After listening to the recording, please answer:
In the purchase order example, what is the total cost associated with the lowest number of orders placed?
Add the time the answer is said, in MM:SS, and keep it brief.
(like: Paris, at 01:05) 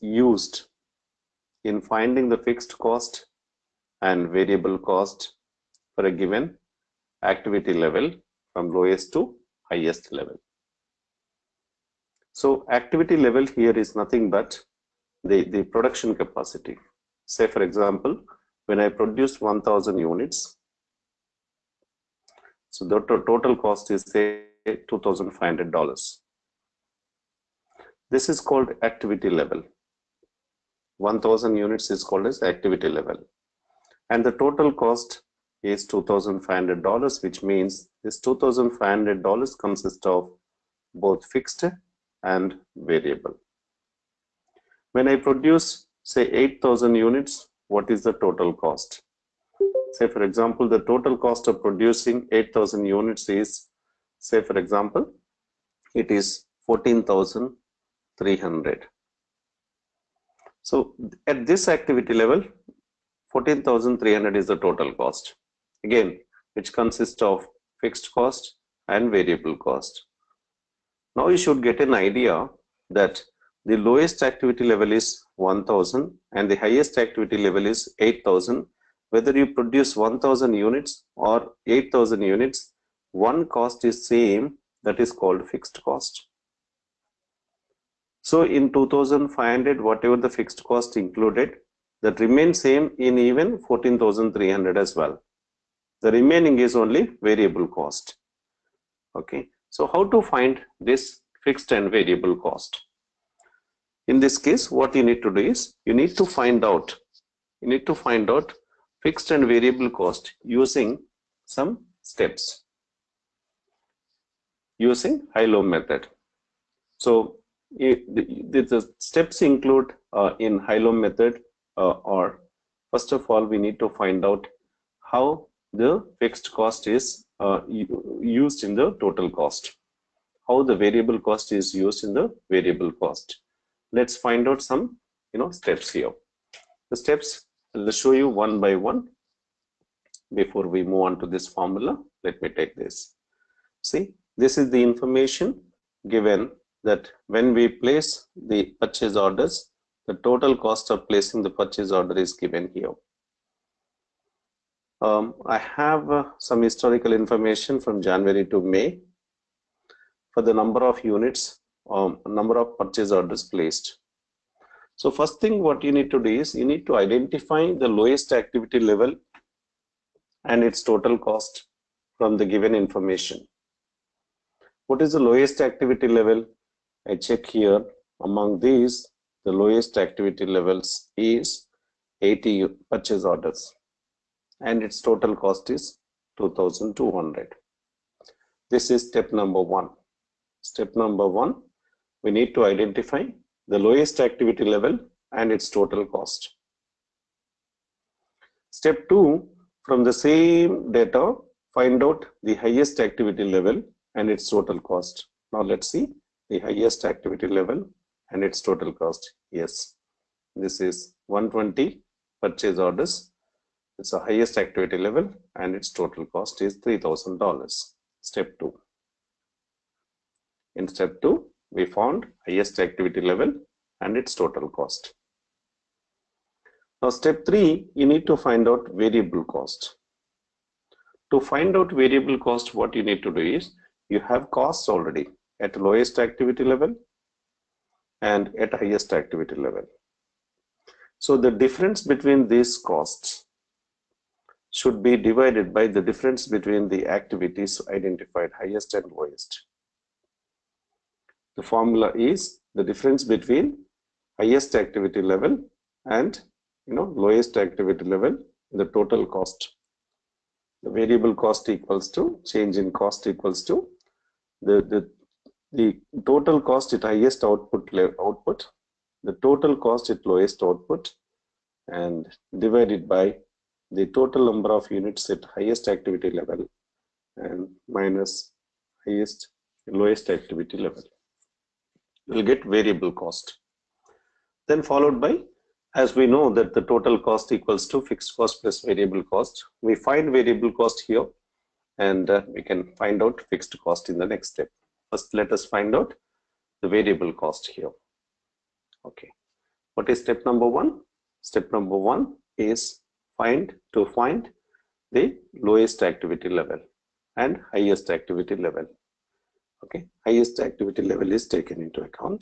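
2200, at 03:06.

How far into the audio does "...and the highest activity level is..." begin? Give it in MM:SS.
01:16.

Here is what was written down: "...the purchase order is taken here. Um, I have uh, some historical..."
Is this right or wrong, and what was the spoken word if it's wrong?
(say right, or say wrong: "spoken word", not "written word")
wrong: "given", not "taken".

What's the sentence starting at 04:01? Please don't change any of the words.
So the difference between these costs should be divided by the difference between the activities identified highest and lowest.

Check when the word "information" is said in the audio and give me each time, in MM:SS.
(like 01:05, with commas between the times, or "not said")
02:24, 02:37, 02:52.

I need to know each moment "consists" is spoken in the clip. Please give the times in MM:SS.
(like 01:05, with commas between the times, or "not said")
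00:39, 01:06.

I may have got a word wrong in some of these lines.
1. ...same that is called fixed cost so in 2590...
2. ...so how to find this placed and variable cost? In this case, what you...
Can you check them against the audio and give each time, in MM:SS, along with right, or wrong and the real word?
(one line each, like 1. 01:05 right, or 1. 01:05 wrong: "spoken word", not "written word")
1. 01:24 wrong: "2500", not "2590"
2. 01:39 wrong: "fixed", not "placed".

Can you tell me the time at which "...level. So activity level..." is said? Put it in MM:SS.
00:10.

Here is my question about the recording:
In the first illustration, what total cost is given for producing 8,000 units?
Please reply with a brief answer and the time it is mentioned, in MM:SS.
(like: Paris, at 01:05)
14,300, at 00:56.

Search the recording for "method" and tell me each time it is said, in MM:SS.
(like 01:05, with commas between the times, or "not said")
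01:55, 02:00.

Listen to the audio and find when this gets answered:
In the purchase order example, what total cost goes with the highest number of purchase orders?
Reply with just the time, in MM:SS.
03:36.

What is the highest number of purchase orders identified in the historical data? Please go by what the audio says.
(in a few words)
120.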